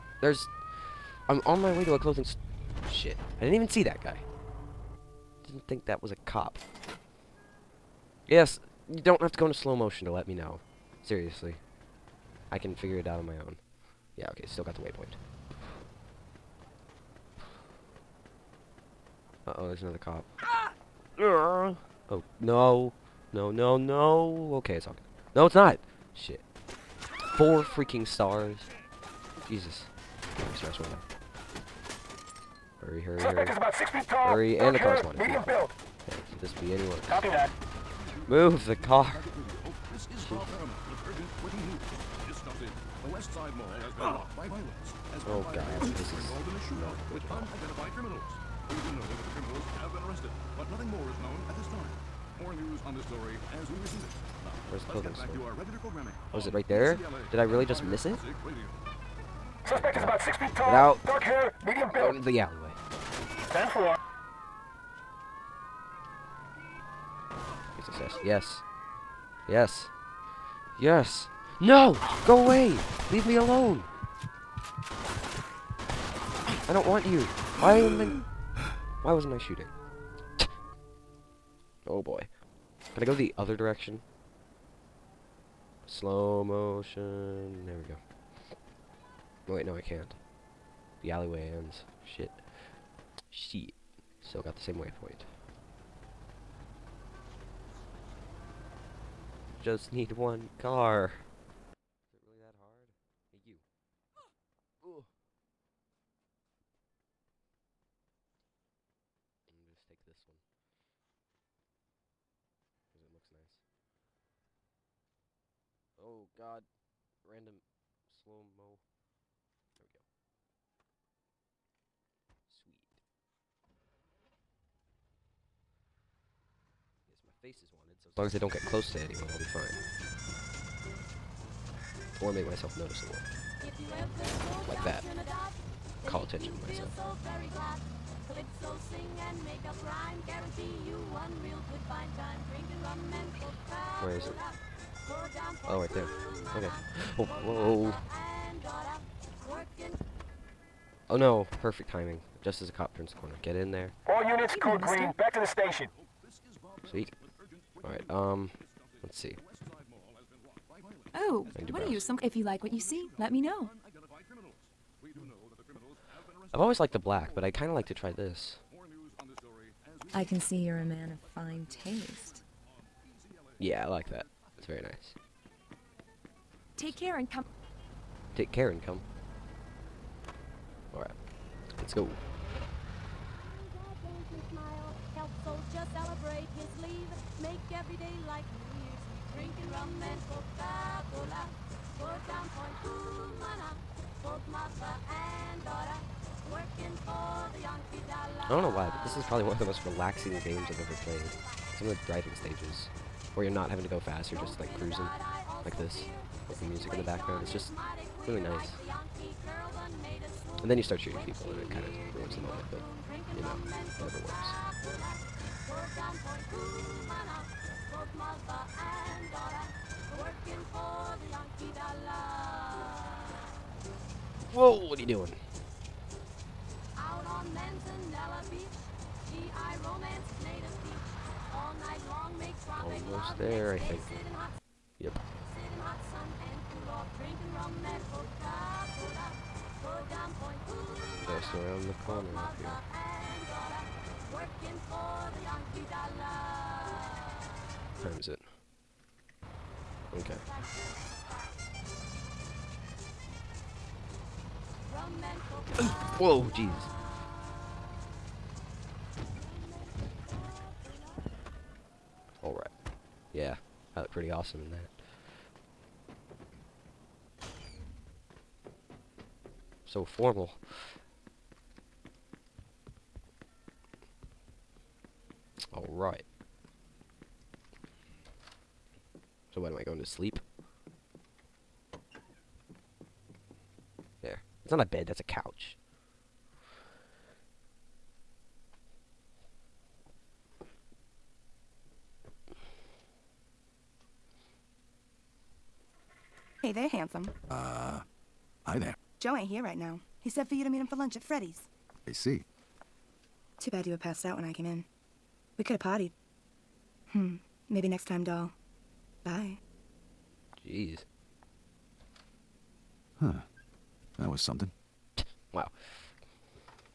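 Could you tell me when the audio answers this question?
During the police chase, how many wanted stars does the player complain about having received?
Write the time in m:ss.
0:27.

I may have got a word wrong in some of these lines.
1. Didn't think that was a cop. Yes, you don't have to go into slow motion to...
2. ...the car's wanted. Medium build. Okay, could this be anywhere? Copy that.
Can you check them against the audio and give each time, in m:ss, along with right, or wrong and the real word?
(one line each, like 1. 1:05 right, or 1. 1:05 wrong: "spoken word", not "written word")
1. 0:05 right
2. 0:34 right.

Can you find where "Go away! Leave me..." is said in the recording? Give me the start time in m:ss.
1:12.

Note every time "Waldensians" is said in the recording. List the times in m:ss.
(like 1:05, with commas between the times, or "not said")
not said.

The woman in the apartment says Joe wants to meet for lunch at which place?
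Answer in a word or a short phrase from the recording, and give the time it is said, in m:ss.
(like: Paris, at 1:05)
Freddy's, at 5:01.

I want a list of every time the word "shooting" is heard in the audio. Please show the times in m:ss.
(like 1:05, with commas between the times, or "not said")
1:19, 3:30.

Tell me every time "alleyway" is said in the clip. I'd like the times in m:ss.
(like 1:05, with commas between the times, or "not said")
1:02, 1:31.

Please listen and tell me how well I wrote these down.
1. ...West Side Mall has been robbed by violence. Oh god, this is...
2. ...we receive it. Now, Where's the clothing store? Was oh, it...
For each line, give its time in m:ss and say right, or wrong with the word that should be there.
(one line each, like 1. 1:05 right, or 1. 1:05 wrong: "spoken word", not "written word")
1. 0:43 right
2. 0:53 wrong: "building", not "clothing".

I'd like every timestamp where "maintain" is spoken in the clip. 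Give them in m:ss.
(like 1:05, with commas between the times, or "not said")
not said.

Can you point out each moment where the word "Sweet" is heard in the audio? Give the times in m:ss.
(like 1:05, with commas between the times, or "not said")
2:02, 2:36.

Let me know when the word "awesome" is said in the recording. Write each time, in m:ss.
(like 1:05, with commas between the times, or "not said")
4:24.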